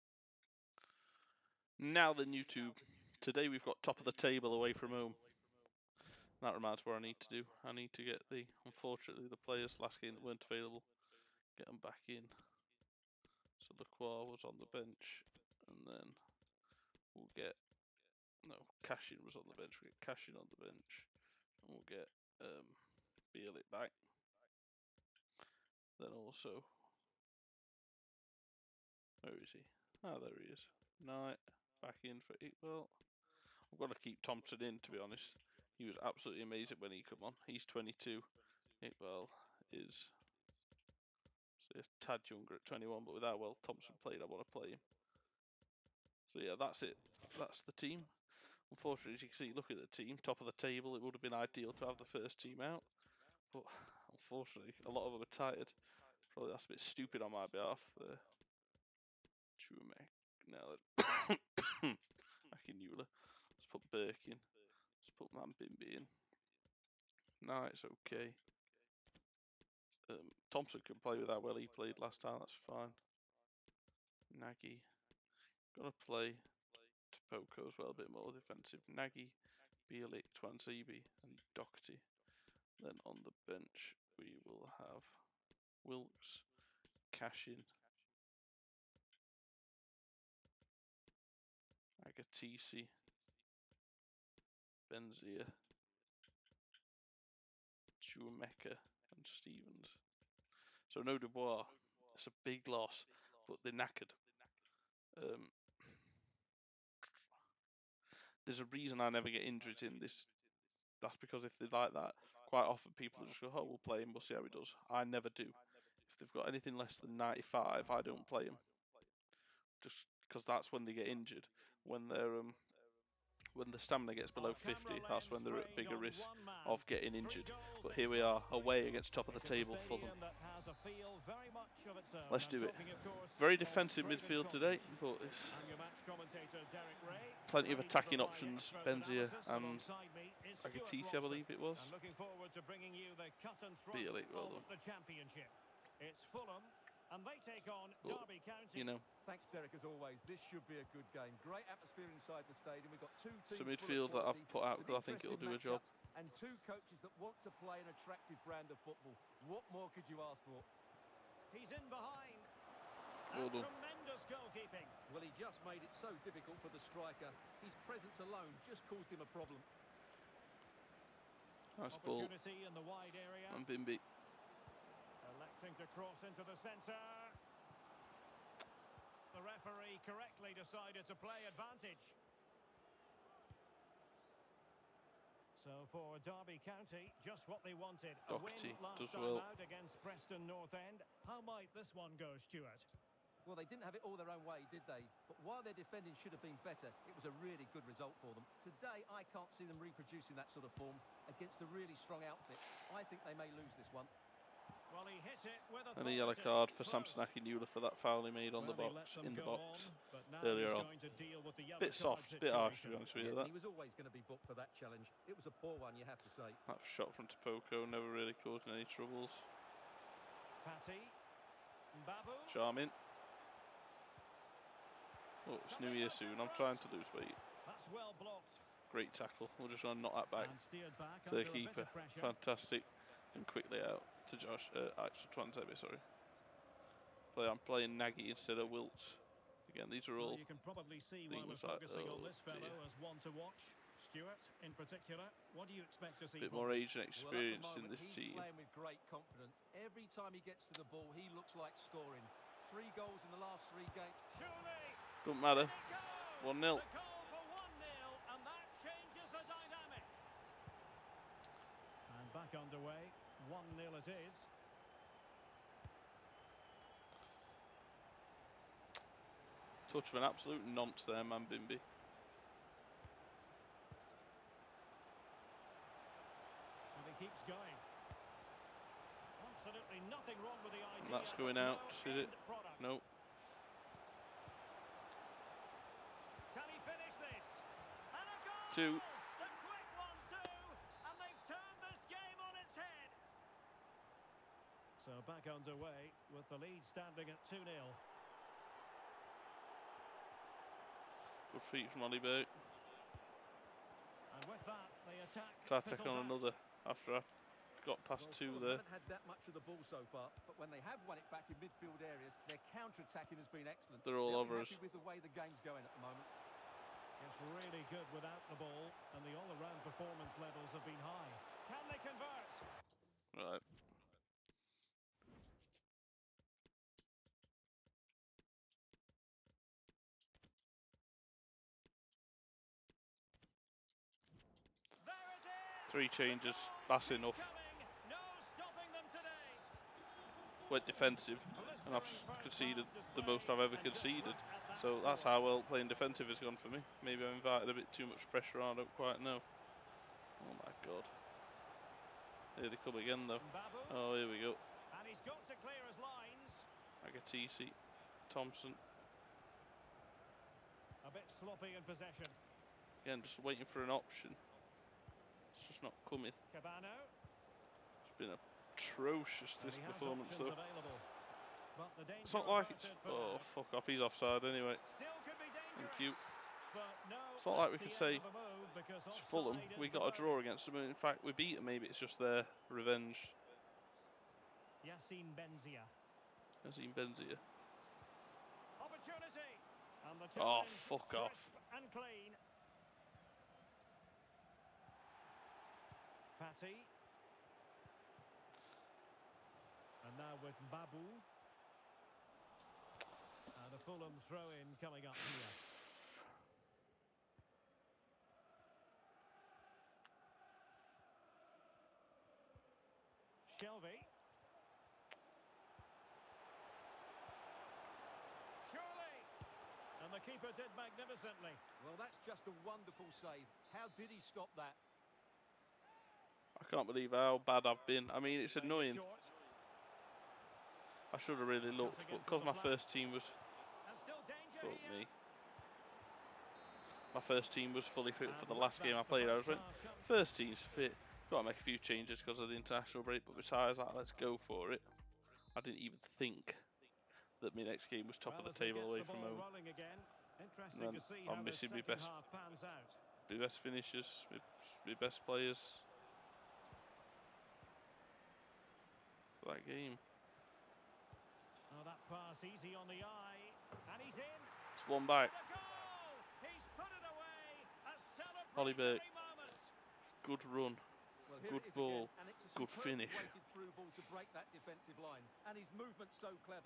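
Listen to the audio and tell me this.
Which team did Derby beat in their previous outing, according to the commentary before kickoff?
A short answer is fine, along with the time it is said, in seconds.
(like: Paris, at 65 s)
Preston North End, at 190 s.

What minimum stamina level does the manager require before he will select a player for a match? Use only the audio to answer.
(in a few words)
95.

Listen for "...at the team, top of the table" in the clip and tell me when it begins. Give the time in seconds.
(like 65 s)
49 s.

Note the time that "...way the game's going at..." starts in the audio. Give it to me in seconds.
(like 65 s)
315 s.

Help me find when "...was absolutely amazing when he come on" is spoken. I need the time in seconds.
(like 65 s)
35 s.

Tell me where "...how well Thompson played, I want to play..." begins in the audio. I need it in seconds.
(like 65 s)
43 s.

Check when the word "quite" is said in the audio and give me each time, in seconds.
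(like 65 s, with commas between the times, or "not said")
112 s, 348 s.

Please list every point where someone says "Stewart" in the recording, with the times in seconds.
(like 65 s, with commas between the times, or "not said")
192 s, 244 s.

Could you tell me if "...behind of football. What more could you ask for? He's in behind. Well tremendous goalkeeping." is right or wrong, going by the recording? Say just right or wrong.
wrong.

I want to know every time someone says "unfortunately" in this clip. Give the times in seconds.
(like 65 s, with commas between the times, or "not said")
8 s, 48 s, 54 s.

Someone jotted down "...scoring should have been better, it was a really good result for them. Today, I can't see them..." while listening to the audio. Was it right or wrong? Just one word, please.
wrong.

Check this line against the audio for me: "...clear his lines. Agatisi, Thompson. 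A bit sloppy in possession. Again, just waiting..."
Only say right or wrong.
right.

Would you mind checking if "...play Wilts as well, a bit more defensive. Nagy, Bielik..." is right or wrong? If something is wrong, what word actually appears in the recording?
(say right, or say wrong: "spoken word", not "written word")
wrong: "Topoko", not "Wilts".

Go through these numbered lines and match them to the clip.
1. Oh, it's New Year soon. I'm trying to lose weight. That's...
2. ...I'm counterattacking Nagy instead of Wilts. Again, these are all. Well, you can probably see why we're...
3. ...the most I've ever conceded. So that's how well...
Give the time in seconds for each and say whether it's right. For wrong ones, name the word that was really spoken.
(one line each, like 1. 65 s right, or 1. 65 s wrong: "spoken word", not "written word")
1. 225 s right
2. 237 s wrong: "playing", not "counterattacking"
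3. 343 s right.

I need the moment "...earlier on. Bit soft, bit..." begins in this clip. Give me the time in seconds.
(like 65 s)
210 s.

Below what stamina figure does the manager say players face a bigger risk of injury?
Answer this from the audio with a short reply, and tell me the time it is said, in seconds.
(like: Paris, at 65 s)
50, at 124 s.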